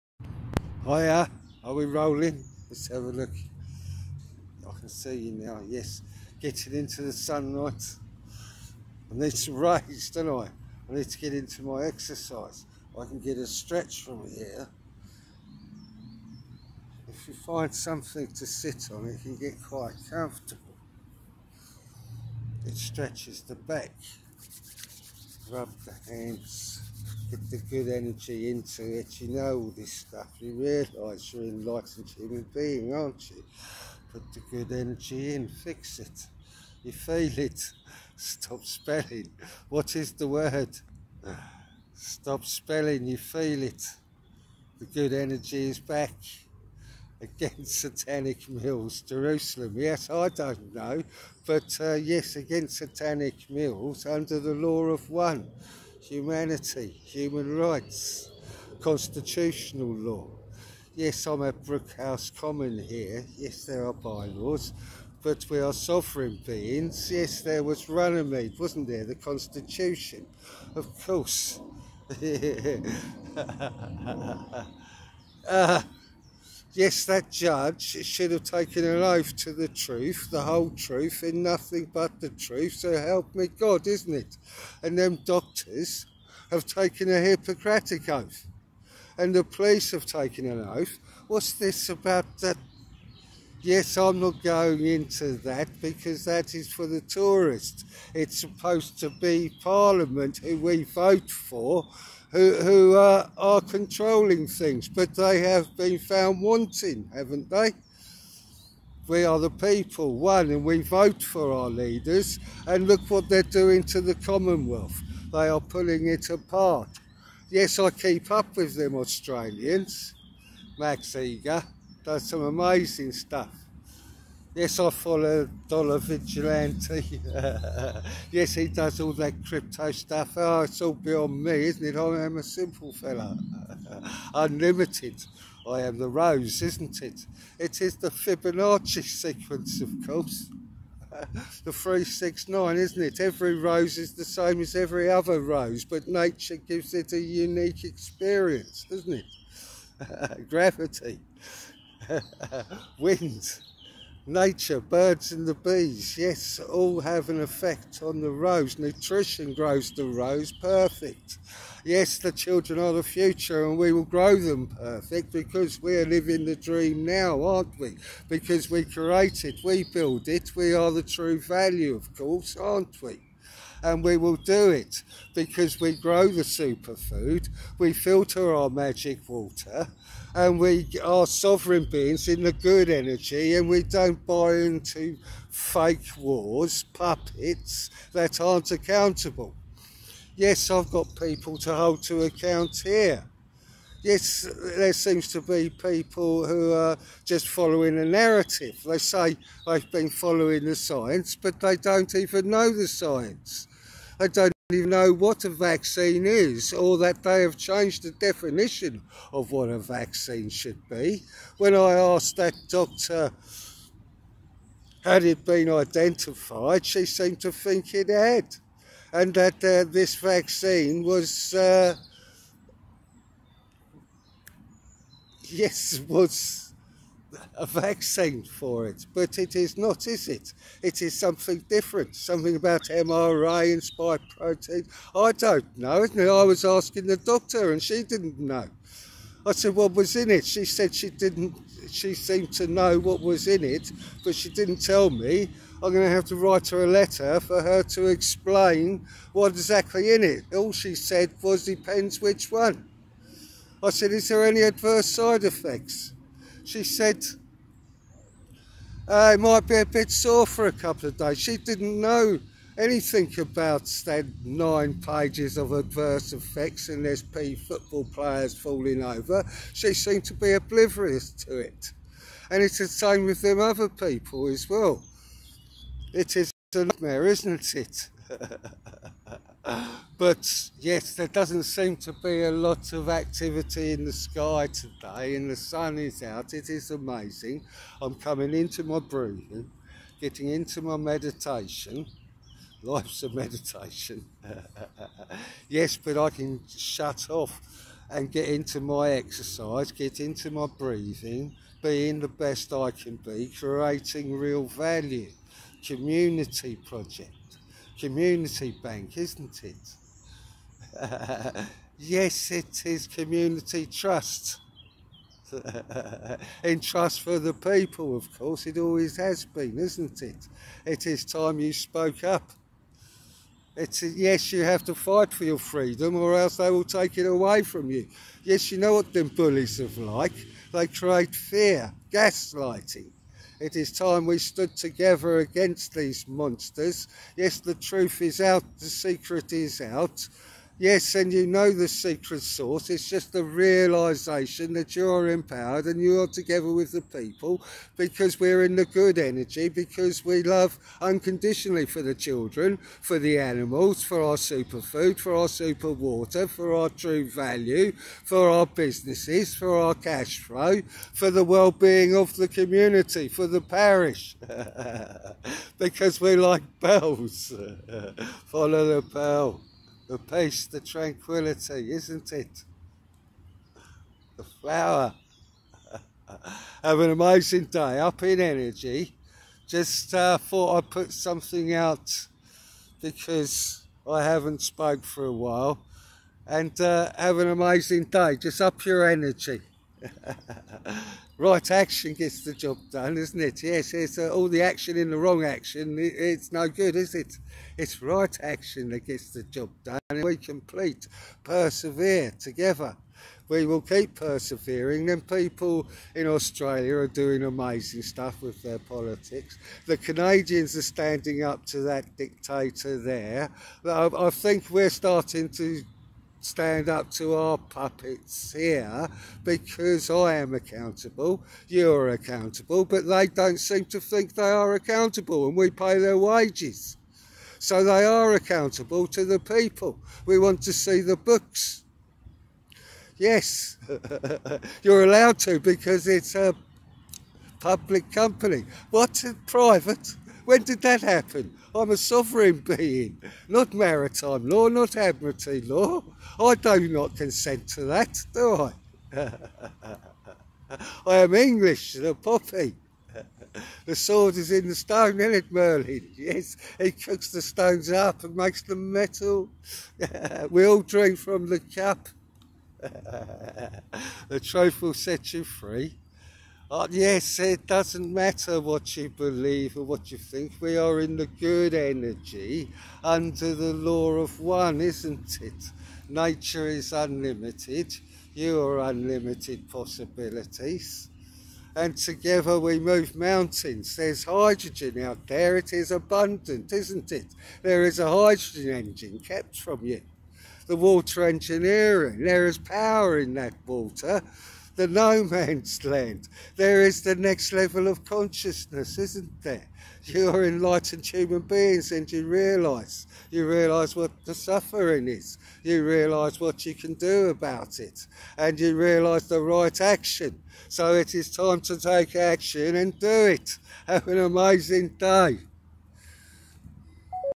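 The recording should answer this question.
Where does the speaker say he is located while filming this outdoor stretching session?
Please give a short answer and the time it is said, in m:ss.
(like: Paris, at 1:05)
Brookhouse Common, at 1:01.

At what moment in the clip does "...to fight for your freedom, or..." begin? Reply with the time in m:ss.
5:24.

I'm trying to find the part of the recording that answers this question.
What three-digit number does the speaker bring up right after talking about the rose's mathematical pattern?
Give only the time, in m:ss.
2:21.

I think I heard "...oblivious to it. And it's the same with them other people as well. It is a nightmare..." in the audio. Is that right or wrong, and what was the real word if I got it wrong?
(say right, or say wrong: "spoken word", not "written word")
right.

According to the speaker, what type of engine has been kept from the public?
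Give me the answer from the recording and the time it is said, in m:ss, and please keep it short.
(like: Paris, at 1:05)
hydrogen engine, at 8:08.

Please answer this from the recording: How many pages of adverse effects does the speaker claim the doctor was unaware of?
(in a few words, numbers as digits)
9.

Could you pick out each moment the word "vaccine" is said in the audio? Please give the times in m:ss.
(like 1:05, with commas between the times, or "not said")
3:25, 3:29, 3:40, 3:47.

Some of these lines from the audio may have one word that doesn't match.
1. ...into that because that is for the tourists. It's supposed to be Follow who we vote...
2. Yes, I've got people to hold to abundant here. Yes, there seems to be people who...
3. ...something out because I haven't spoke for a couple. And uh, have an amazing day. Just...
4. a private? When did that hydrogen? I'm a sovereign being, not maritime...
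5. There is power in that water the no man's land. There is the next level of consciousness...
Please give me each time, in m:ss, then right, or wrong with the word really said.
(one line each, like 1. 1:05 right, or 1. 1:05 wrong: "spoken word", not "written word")
1. 1:34 wrong: "Parliament", not "Follow"
2. 3:10 wrong: "account", not "abundant"
3. 6:21 wrong: "while", not "couple"
4. 7:18 wrong: "happen", not "hydrogen"
5. 8:12 right.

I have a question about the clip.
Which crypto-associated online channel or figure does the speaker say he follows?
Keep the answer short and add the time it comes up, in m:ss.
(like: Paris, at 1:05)
Dollar Vigilante, at 2:05.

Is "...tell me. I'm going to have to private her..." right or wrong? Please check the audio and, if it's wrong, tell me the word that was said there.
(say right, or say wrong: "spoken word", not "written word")
wrong: "write", not "private".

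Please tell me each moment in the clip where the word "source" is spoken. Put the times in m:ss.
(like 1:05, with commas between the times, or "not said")
5:42.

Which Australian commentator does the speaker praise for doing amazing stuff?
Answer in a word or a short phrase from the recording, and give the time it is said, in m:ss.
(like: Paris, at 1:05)
Max Igan, at 2:00.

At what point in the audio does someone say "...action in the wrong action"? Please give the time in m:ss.
6:34.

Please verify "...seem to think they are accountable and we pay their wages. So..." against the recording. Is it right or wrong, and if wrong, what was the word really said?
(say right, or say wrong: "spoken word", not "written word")
right.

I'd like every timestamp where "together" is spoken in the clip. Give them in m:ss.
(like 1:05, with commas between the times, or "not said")
5:34, 5:46, 6:42, 8:01.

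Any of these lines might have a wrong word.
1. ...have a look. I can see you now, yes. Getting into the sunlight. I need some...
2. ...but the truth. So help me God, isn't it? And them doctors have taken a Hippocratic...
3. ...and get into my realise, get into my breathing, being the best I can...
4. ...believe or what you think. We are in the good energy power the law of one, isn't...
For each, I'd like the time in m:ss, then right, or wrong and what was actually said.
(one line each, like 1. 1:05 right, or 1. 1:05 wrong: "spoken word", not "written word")
1. 0:02 right
2. 1:21 right
3. 4:58 wrong: "exercise", not "realise"
4. 7:49 wrong: "under", not "power".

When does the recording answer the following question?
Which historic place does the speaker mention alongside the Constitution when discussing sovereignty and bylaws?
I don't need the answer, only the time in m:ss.
1:07.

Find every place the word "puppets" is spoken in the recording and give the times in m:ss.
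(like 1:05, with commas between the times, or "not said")
3:06, 6:57.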